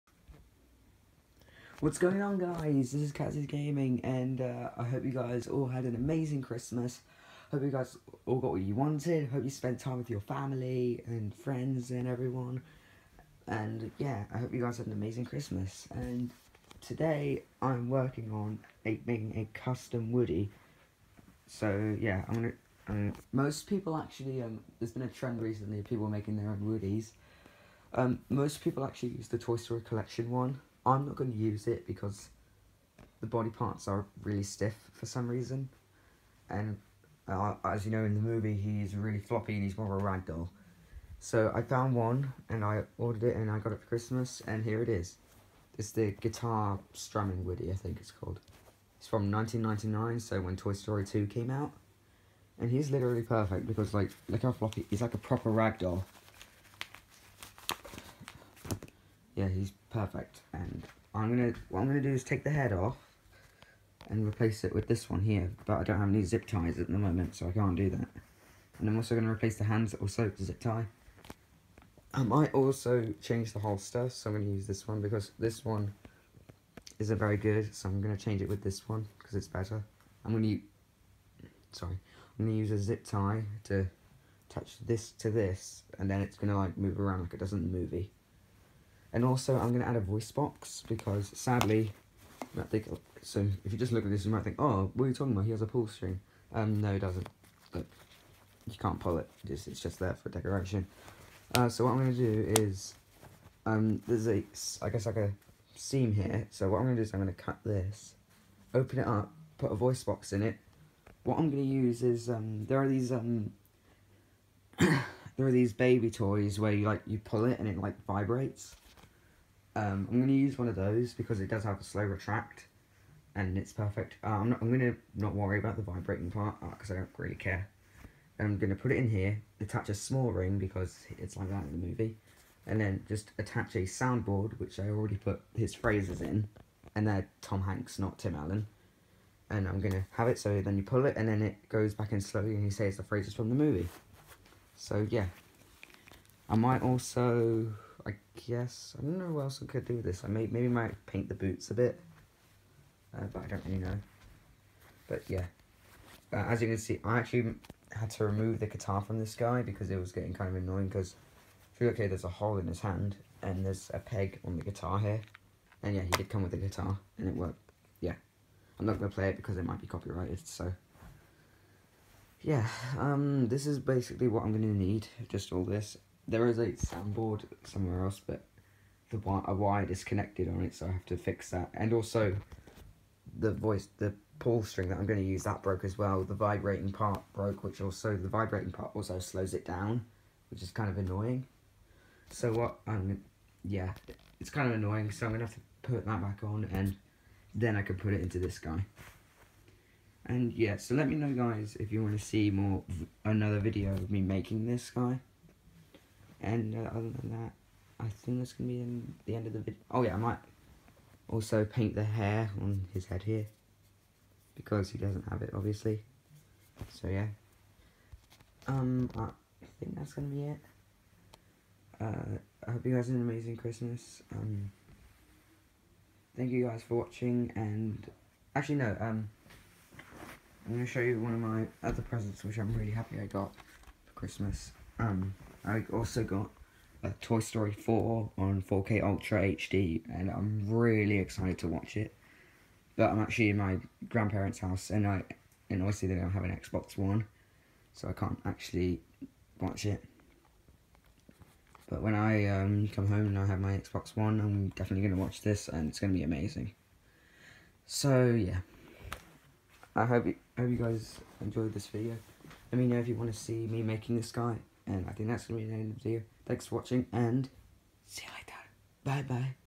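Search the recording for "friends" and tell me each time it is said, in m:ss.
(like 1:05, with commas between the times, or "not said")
0:11.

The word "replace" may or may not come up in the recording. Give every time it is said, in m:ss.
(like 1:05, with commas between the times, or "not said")
1:04, 1:09.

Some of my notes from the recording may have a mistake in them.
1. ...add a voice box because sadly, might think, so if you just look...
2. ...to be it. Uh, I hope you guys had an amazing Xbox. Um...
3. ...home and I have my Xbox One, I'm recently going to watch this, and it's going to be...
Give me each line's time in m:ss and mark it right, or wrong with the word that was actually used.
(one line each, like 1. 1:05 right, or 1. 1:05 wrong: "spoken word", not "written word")
1. 1:29 right
2. 3:40 wrong: "Christmas", not "Xbox"
3. 4:13 wrong: "definitely", not "recently".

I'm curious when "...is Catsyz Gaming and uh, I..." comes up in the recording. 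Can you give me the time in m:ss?
0:03.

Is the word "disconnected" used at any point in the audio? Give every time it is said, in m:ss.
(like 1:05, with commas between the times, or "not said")
2:59.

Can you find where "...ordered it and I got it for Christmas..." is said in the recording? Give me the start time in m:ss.
0:42.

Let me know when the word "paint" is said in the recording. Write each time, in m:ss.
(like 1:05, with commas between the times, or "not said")
2:31, 3:31.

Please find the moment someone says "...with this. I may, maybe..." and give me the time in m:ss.
2:29.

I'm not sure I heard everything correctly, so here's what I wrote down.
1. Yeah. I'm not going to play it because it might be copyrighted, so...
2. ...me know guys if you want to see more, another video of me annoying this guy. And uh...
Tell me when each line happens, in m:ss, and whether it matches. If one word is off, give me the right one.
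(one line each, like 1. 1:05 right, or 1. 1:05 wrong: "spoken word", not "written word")
1. 2:47 right
2. 3:21 wrong: "making", not "annoying".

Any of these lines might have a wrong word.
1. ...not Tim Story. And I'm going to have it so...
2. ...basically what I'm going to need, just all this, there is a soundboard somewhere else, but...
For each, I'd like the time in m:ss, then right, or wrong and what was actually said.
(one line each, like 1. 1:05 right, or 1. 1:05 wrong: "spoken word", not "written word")
1. 2:17 wrong: "Allen", not "Story"
2. 2:53 right.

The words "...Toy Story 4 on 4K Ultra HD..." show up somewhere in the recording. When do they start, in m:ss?
3:57.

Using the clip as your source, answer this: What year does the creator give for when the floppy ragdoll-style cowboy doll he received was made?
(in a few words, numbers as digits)
1999.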